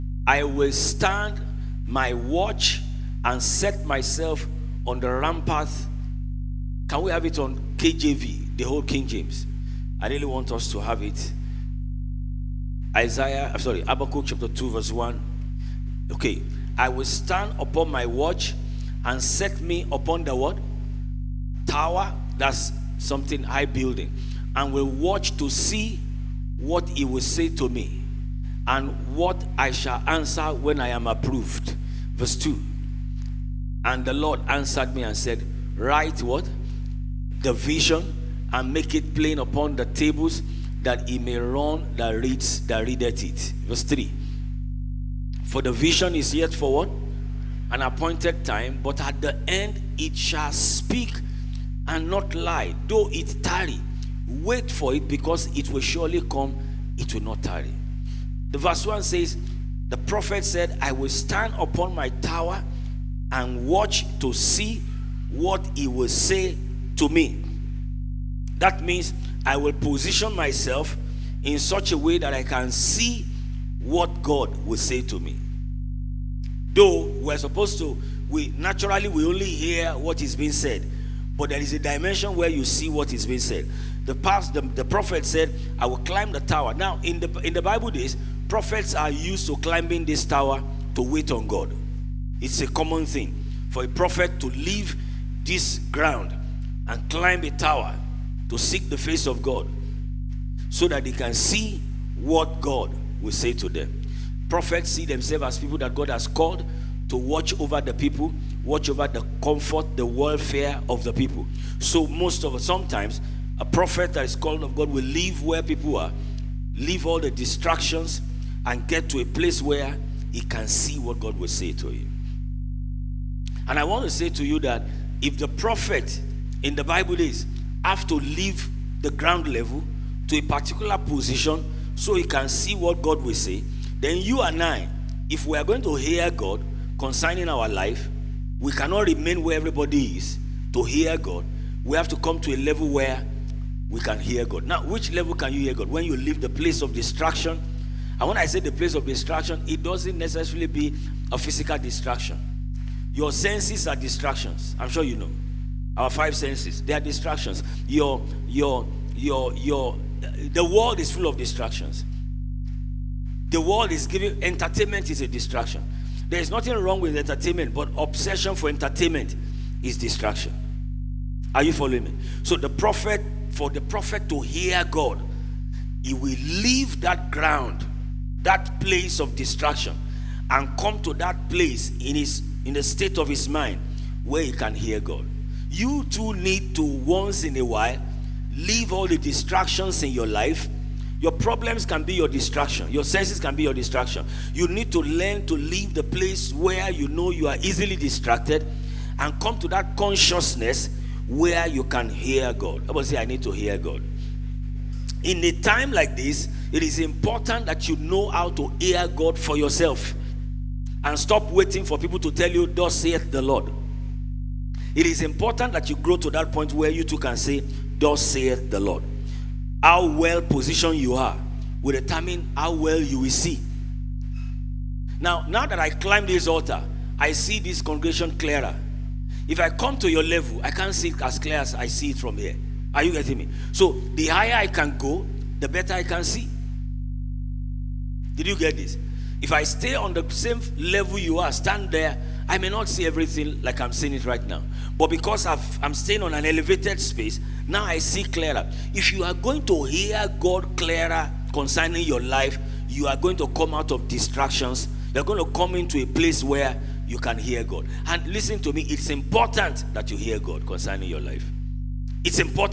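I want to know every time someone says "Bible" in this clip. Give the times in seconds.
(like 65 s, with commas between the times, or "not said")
87 s, 126 s.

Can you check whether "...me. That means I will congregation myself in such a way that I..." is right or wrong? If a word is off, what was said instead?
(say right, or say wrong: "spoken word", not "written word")
wrong: "position", not "congregation".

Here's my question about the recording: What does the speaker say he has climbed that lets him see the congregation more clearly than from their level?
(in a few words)
this altar.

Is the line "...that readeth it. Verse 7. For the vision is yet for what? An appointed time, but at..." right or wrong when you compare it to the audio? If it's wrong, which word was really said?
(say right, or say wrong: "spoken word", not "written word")
wrong: "3", not "7".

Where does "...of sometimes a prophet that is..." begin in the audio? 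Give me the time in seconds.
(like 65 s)
112 s.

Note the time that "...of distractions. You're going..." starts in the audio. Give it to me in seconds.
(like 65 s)
253 s.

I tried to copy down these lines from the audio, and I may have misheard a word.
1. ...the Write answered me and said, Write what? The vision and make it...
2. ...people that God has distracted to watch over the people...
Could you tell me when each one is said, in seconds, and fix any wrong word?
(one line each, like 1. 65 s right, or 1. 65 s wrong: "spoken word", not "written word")
1. 34 s wrong: "Lord", not "Write"
2. 105 s wrong: "called", not "distracted".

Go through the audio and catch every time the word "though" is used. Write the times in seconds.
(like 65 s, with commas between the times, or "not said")
52 s, 76 s.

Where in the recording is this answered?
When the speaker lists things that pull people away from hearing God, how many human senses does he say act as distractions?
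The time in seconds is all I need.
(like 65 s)
156 s.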